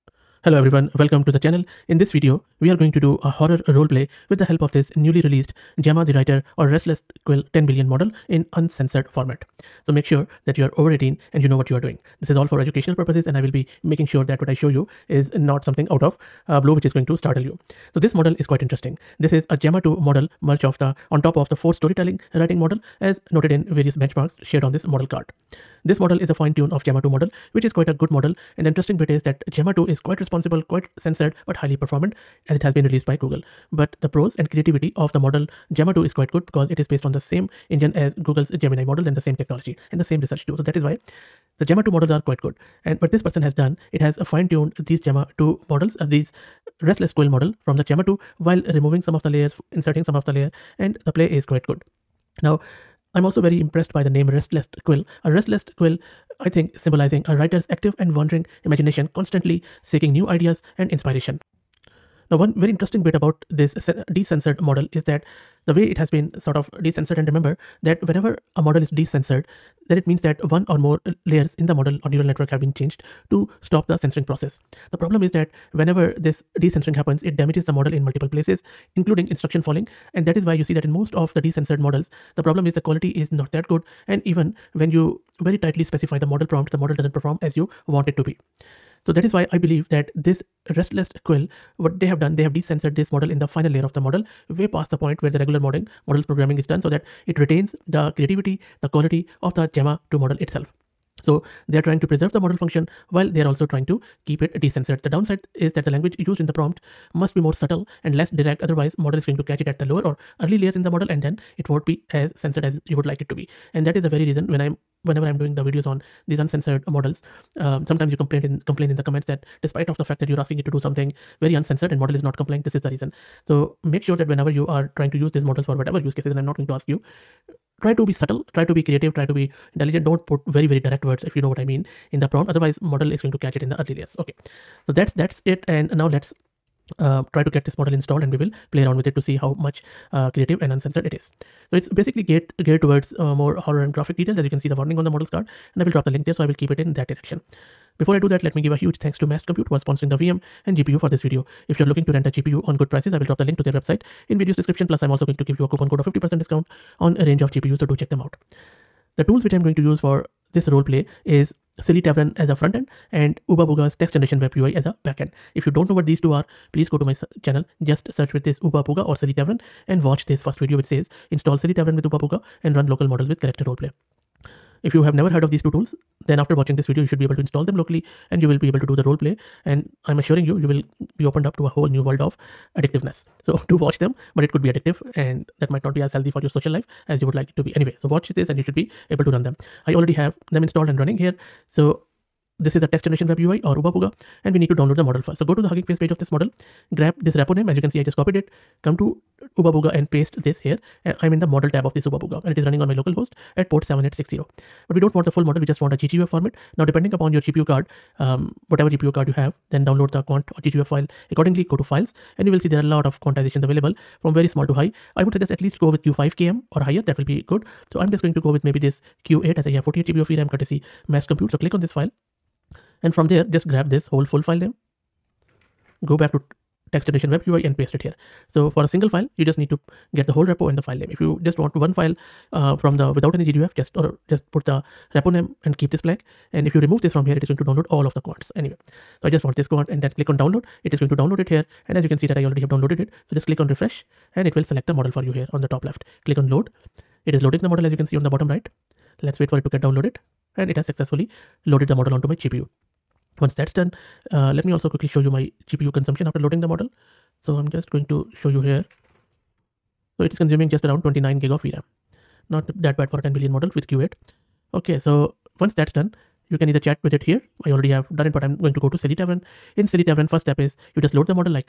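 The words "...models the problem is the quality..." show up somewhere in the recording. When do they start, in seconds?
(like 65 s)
81 s.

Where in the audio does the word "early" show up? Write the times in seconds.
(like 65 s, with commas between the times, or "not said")
110 s, 133 s.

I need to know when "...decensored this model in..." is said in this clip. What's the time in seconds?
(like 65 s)
92 s.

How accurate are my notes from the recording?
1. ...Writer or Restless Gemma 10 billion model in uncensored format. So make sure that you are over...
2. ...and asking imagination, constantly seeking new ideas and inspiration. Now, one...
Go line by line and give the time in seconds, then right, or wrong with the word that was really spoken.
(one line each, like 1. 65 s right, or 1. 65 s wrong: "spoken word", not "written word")
1. 6 s wrong: "Quill", not "Gemma"
2. 57 s wrong: "wandering", not "asking".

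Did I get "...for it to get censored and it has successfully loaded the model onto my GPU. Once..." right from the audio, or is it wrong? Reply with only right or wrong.
wrong.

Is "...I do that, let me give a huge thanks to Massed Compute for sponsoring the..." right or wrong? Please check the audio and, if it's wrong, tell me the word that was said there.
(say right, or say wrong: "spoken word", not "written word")
right.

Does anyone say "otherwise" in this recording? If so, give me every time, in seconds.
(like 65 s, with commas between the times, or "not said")
108 s, 132 s.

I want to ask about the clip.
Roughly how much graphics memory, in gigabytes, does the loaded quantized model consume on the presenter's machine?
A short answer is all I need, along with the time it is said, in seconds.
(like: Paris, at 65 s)
29 GB, at 261 s.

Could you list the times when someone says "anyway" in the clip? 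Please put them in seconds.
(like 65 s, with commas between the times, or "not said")
187 s, 238 s.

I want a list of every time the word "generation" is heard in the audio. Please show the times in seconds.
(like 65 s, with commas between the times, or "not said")
164 s, 193 s, 227 s.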